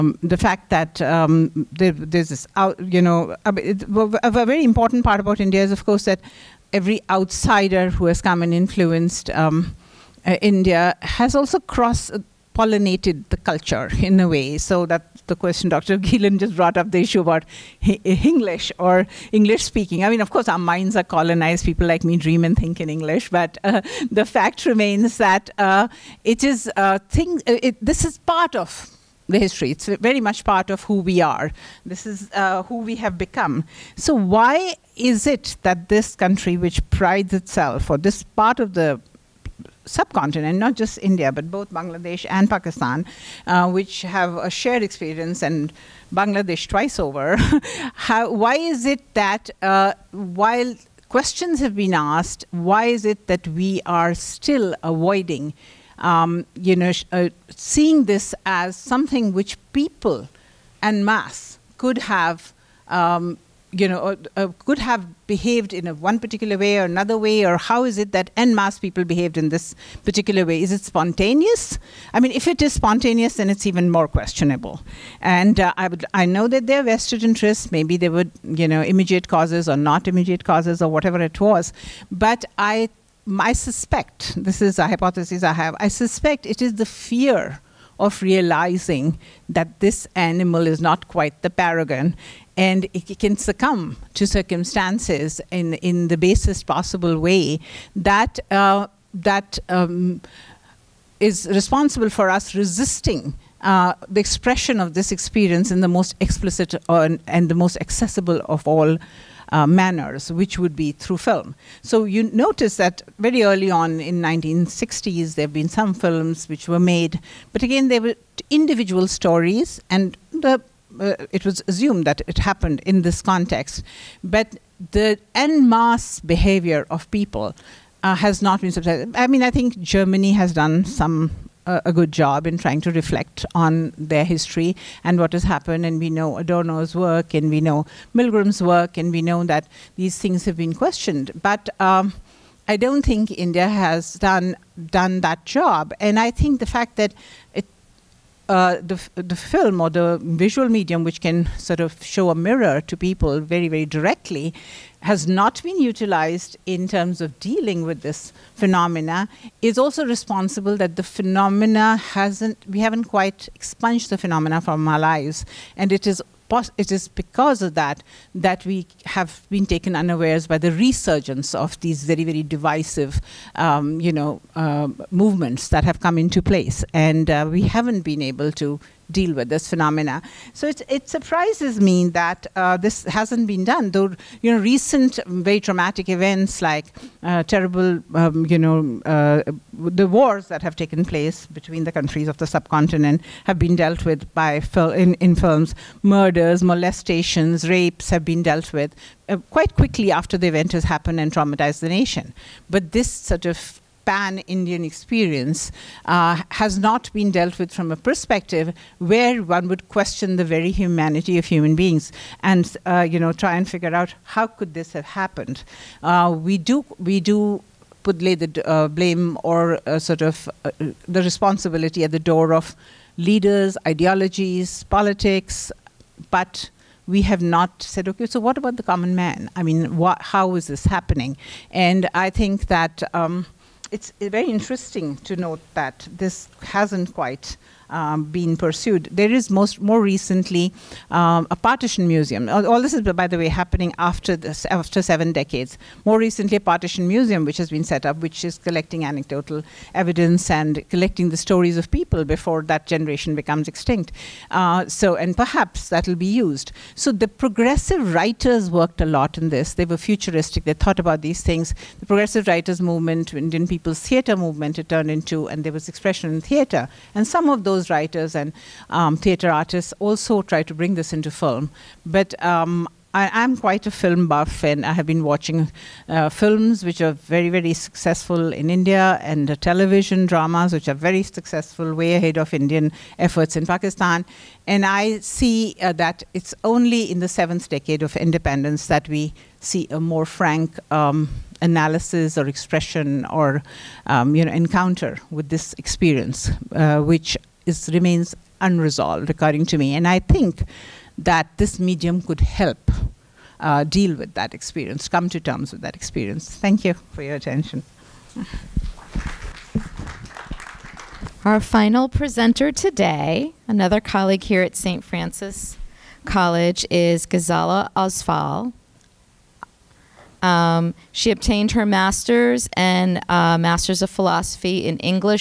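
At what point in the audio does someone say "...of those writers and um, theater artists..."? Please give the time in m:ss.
4:27.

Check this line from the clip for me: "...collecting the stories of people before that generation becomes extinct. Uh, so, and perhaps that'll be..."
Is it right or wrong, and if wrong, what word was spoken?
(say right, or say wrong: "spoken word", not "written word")
right.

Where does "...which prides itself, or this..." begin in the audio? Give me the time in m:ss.
0:36.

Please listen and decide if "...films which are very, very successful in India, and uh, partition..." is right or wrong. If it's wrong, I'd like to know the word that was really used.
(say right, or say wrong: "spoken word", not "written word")
wrong: "television", not "partition".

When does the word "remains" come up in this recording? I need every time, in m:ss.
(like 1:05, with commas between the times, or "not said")
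0:24, 4:57.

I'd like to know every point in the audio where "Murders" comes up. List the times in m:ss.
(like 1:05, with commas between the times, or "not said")
3:16.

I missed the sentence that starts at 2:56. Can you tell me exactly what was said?
And uh, we haven't been able to deal with this phenomena.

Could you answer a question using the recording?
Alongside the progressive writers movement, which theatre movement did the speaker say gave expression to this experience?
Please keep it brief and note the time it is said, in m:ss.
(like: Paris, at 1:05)
Indian People's Theatre movement, at 4:23.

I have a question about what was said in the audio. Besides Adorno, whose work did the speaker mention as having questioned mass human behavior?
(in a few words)
Milgram.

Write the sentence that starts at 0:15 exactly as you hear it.
Gielen just brought up the issue about English or English speaking.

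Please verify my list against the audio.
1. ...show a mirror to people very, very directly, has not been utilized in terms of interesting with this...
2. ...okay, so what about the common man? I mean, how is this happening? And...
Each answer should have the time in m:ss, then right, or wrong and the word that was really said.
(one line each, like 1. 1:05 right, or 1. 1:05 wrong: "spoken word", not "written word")
1. 2:32 wrong: "dealing", not "interesting"
2. 3:48 right.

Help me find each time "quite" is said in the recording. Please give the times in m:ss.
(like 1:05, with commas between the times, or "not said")
1:31, 2:43, 3:19, 3:57, 4:33.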